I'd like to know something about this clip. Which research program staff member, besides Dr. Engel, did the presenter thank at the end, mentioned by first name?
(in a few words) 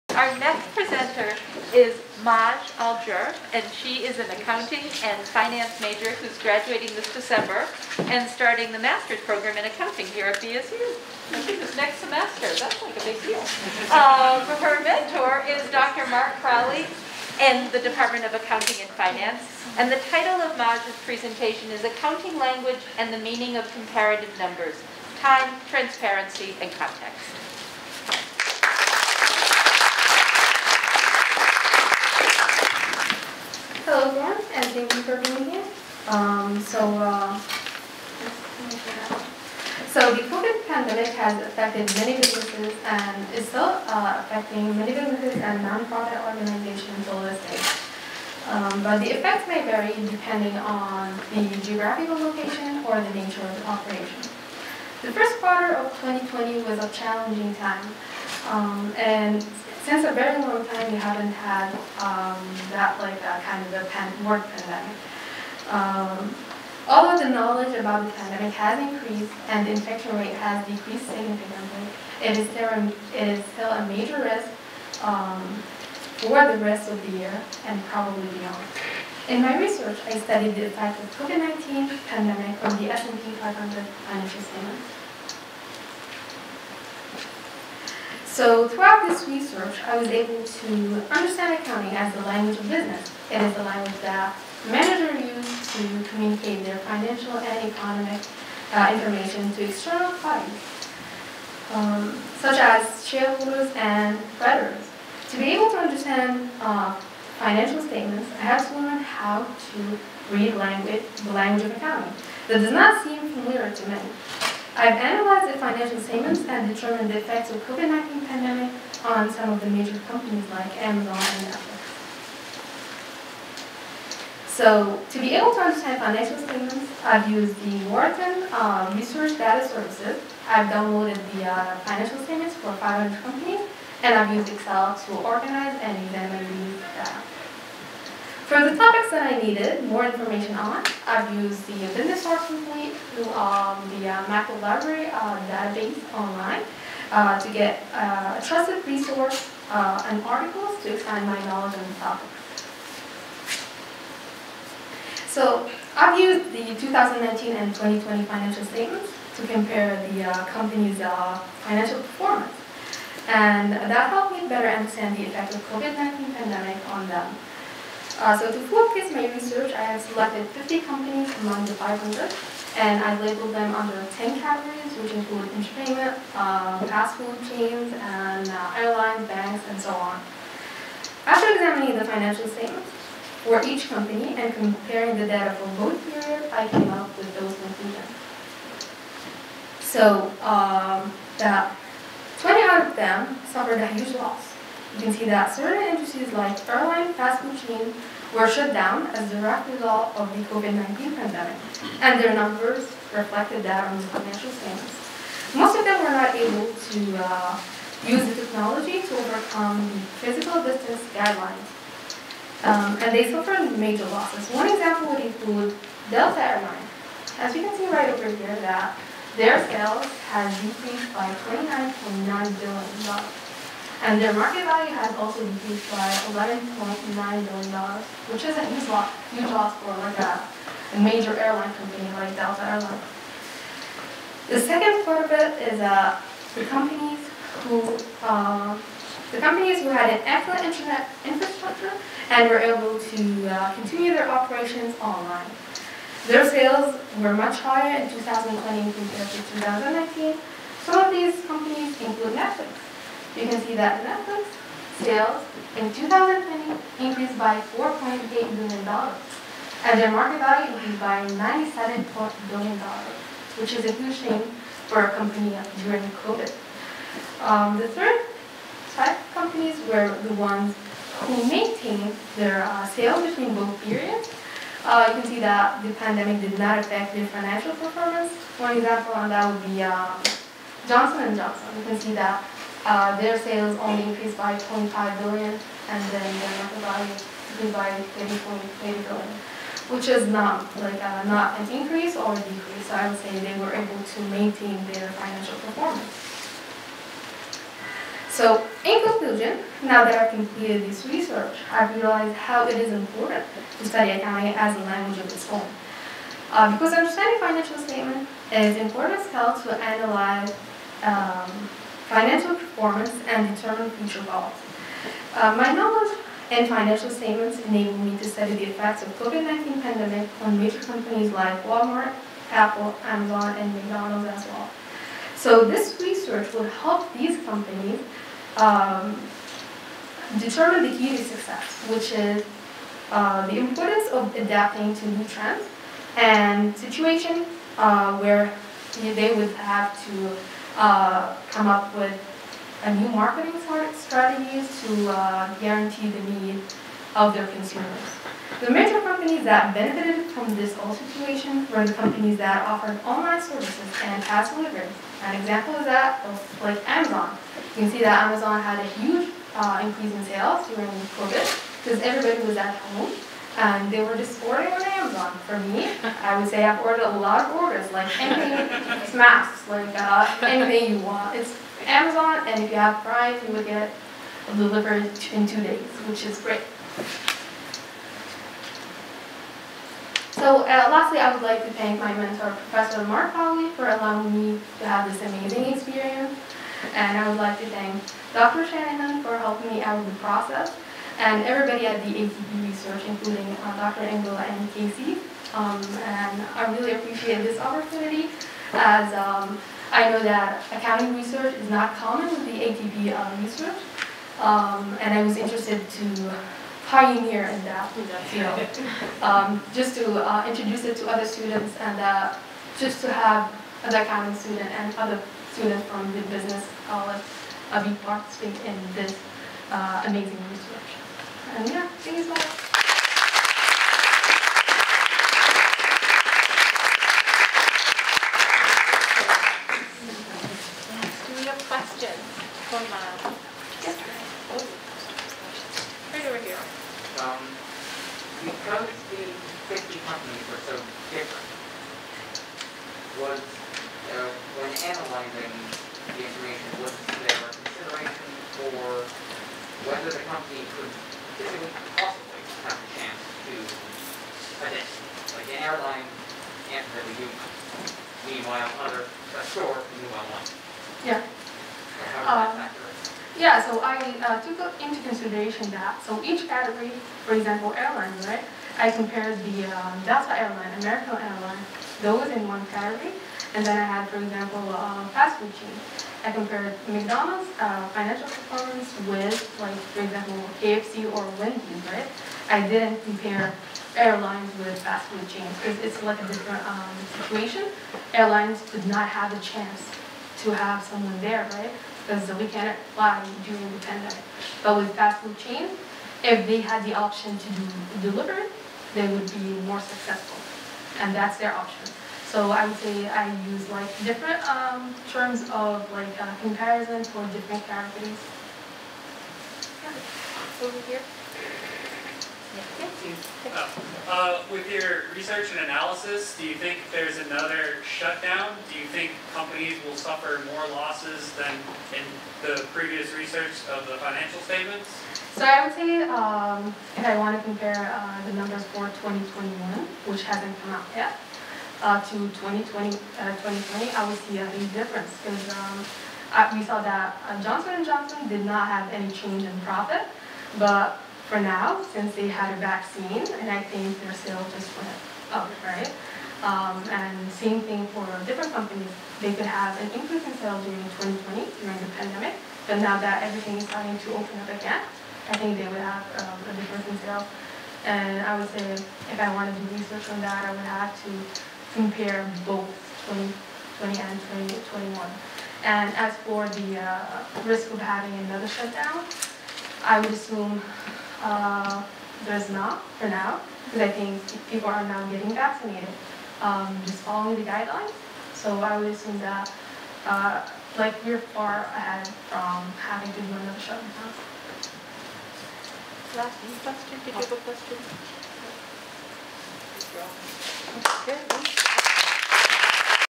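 Casey.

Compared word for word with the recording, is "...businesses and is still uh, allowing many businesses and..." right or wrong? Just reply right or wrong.
wrong.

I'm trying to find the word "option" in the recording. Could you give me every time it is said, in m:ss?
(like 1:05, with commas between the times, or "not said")
8:16, 8:21.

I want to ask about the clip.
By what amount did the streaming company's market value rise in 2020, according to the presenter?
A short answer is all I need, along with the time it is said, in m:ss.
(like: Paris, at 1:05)
$97 billion, at 4:21.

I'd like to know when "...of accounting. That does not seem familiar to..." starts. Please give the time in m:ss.
1:51.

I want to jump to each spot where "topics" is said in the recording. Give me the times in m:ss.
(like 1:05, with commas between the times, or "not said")
2:18, 2:31.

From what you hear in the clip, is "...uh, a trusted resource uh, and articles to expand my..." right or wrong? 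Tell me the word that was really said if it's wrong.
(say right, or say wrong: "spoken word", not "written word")
right.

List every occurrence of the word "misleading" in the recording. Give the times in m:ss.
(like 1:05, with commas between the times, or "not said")
not said.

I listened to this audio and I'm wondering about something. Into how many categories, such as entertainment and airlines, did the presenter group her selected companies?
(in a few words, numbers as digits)
10.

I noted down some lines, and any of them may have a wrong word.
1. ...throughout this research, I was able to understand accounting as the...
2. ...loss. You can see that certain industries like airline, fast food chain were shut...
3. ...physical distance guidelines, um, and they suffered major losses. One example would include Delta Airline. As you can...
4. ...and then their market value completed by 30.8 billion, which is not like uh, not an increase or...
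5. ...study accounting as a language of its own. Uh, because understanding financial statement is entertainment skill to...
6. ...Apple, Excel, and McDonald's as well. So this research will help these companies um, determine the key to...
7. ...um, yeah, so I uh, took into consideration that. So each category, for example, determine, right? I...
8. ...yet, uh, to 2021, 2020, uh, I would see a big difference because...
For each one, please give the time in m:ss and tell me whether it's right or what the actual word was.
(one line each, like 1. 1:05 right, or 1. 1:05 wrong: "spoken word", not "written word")
1. 1:28 right
2. 3:14 right
3. 3:30 right
4. 4:45 wrong: "increased", not "completed"
5. 5:03 wrong: "important", not "entertainment"
6. 5:22 wrong: "Amazon", not "Excel"
7. 7:42 wrong: "airline", not "determine"
8. 8:50 wrong: "2020", not "2021".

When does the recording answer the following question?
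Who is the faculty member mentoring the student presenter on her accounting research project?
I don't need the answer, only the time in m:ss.
0:15.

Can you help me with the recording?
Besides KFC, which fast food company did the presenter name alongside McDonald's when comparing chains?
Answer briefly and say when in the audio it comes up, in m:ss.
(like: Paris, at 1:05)
Wendy's, at 8:01.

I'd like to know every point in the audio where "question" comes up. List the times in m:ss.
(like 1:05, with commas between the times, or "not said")
7:11, 9:46, 9:51.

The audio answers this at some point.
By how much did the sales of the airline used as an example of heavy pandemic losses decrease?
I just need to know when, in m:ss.
3:41.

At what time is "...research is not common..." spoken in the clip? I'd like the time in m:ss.
6:41.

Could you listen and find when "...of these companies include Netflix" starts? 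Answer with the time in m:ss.
4:11.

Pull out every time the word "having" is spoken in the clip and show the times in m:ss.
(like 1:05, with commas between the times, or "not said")
9:27, 9:42.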